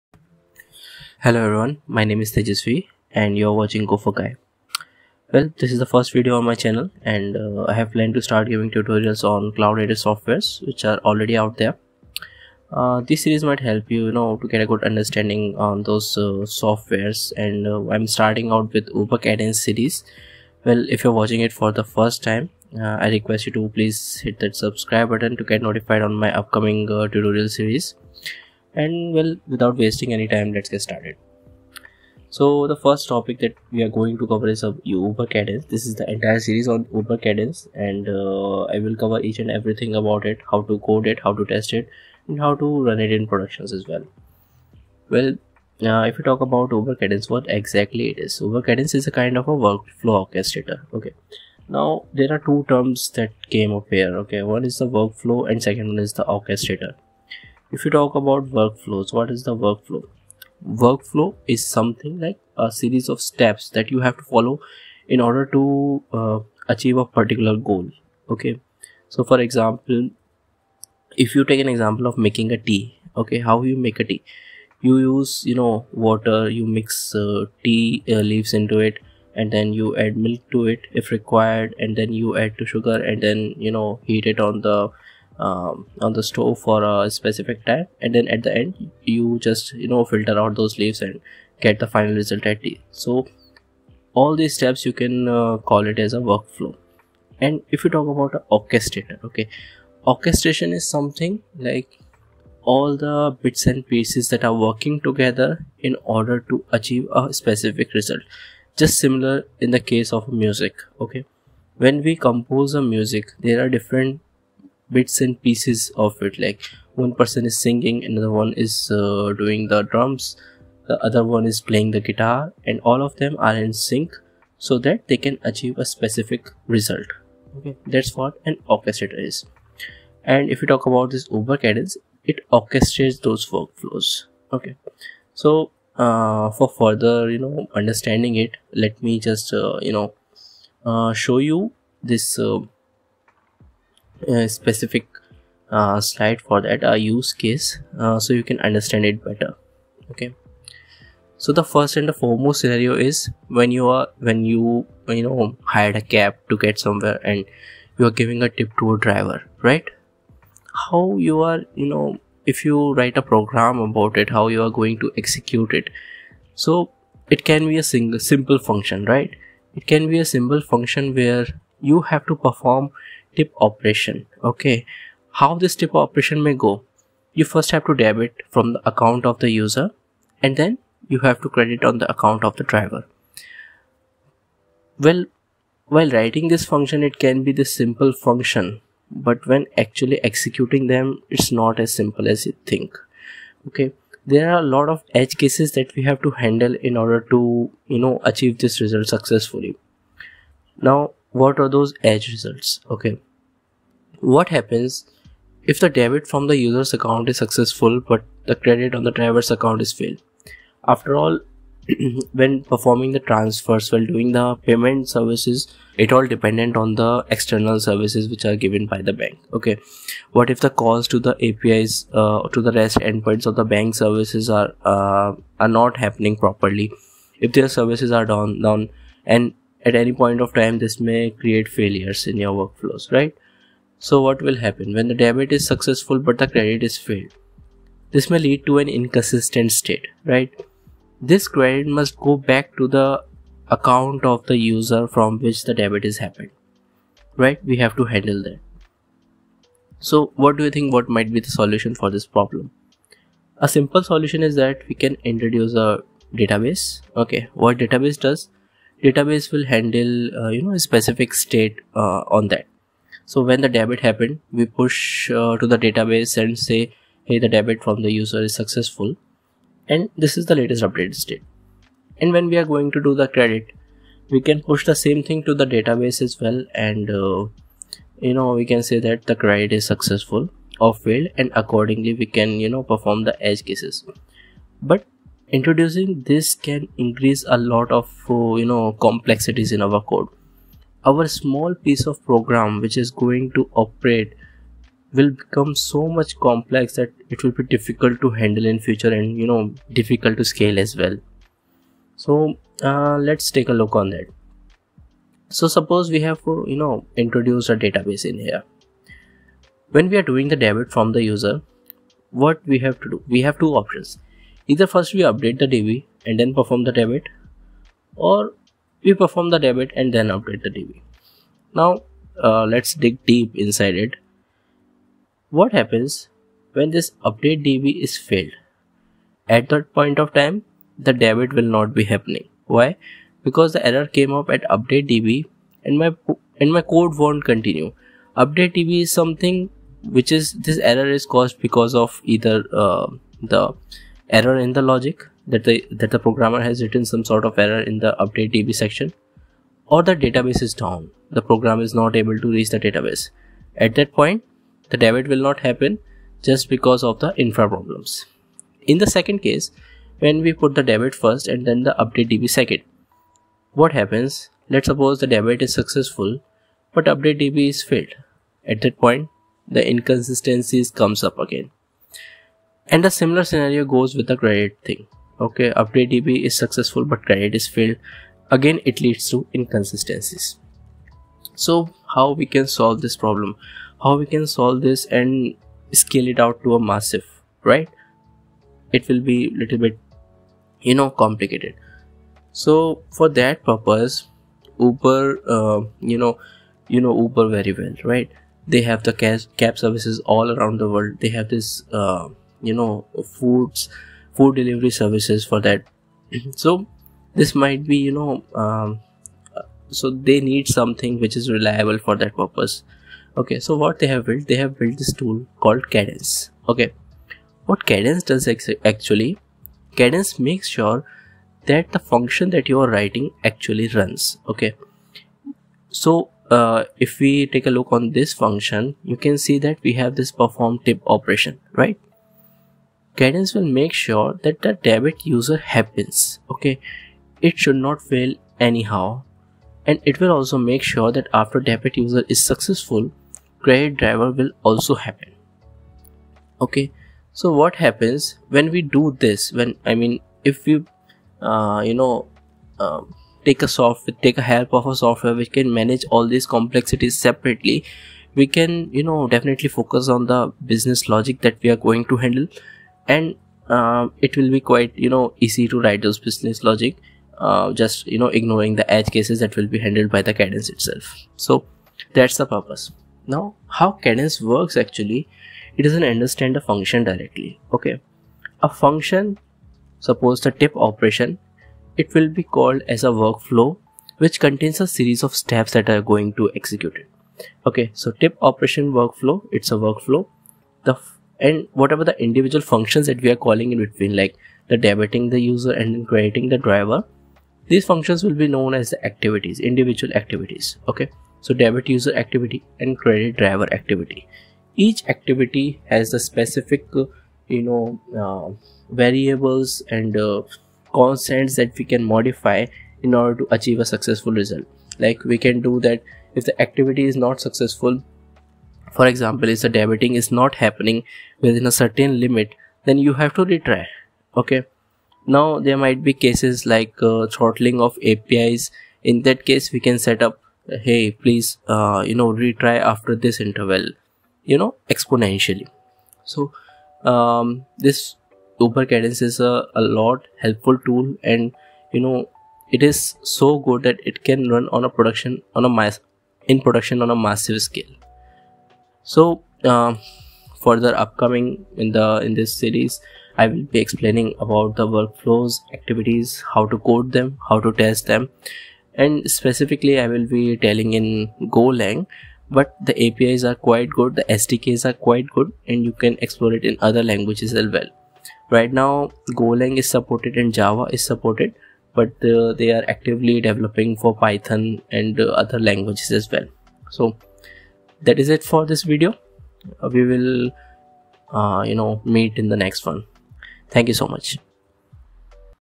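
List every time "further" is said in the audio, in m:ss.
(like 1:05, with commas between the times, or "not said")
2:16, 9:10.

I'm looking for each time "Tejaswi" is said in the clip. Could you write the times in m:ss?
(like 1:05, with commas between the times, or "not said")
0:02.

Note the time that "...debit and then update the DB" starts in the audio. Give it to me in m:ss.
5:19.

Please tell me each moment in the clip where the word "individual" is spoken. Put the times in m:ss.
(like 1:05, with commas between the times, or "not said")
8:12, 8:19.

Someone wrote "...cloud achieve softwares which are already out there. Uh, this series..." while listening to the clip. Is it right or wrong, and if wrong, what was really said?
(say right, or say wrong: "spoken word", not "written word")
wrong: "native", not "achieve".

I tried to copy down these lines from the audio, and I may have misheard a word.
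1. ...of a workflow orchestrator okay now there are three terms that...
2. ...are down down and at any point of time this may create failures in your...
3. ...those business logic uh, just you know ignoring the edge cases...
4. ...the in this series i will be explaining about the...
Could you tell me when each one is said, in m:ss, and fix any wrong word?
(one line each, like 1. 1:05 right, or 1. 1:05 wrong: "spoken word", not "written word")
1. 0:49 wrong: "two", not "three"
2. 3:48 right
3. 7:46 right
4. 9:11 right.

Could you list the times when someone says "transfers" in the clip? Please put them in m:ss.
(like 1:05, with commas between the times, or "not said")
3:33.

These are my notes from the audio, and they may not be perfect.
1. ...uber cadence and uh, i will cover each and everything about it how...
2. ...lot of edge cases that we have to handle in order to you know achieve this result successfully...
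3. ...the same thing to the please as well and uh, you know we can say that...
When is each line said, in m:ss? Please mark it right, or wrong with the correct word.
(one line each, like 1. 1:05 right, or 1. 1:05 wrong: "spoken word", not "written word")
1. 0:36 right
2. 3:14 right
3. 4:34 wrong: "database", not "please".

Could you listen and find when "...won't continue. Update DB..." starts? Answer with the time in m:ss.
5:37.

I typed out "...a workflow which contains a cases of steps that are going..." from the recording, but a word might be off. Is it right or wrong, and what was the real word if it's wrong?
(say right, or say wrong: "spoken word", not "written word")
wrong: "series", not "cases".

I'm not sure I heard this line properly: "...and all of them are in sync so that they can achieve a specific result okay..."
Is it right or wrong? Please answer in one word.
right.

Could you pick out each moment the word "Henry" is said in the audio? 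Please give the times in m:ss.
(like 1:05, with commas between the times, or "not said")
not said.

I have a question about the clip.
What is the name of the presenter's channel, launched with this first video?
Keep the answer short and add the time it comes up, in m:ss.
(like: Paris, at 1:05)
Gopher Guy, at 0:03.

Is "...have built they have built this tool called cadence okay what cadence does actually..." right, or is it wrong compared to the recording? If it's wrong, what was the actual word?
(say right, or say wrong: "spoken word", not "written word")
right.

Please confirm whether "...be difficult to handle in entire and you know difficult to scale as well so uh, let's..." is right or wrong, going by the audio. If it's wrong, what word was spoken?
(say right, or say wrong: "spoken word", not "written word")
wrong: "future", not "entire".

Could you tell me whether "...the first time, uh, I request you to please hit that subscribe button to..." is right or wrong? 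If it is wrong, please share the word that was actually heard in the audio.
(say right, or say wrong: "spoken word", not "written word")
right.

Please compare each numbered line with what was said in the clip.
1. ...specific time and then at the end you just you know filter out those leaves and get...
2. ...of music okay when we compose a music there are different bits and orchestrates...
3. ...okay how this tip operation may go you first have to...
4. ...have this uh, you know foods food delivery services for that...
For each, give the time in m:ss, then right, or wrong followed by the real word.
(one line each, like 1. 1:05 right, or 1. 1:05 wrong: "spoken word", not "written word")
1. 1:27 right
2. 1:50 wrong: "pieces", not "orchestrates"
3. 2:54 right
4. 6:41 right.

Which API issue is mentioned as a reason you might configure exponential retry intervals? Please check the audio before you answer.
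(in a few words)
Throttling.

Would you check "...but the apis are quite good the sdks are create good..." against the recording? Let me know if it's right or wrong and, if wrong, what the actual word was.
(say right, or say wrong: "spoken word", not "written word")
wrong: "quite", not "create".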